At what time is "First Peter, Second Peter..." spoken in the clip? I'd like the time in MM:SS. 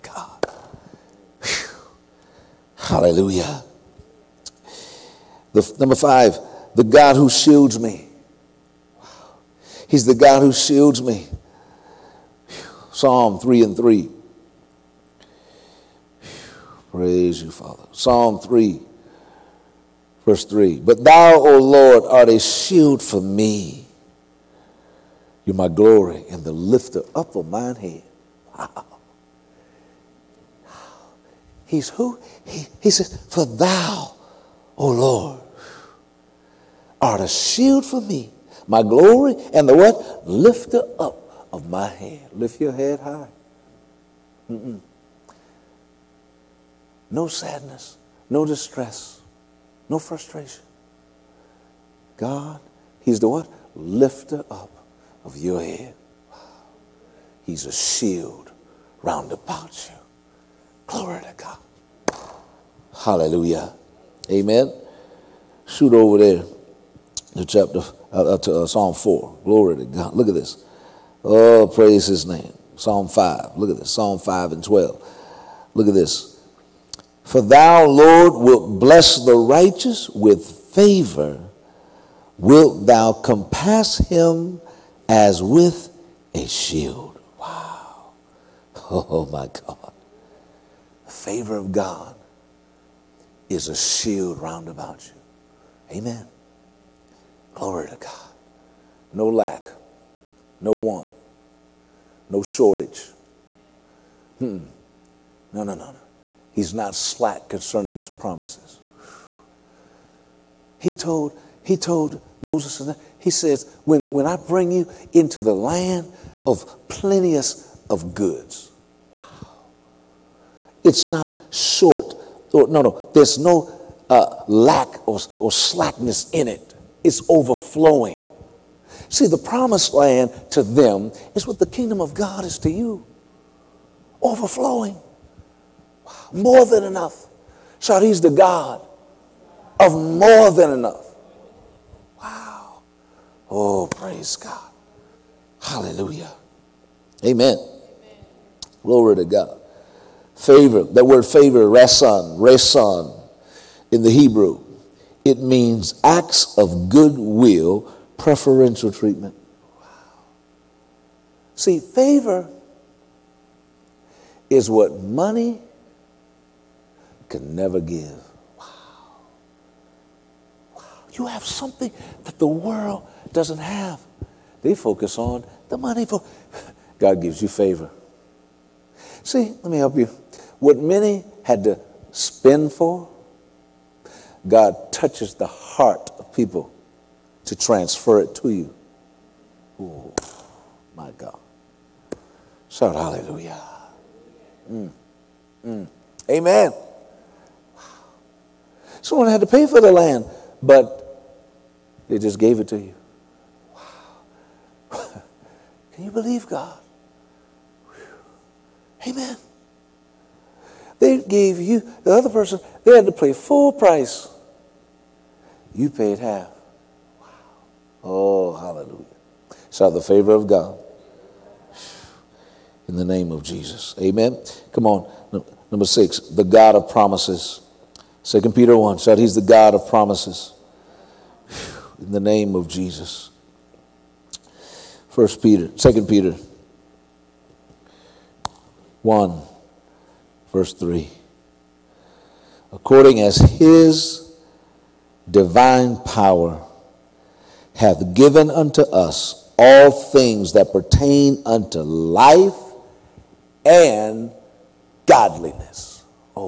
03:55.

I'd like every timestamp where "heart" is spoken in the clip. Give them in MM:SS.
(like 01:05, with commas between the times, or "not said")
03:05.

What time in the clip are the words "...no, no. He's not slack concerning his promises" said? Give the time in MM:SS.
01:45.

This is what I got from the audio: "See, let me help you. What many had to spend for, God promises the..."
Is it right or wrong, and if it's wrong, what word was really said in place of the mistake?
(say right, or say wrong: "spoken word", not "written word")
wrong: "touches", not "promises".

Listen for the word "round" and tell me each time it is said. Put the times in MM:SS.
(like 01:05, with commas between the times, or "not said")
00:59, 01:34.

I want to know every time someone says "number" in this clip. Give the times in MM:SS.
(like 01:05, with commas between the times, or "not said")
00:05, 03:45.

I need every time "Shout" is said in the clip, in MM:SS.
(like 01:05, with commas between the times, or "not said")
03:12, 03:39, 03:48.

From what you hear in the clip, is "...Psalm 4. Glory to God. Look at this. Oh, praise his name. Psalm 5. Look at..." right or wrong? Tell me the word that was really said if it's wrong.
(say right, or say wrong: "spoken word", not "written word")
right.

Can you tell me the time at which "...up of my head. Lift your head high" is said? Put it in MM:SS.
00:40.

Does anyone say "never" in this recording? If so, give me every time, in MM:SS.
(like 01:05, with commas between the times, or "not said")
02:47.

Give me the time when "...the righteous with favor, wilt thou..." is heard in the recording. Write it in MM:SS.
01:19.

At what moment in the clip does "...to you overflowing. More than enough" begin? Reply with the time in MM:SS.
02:12.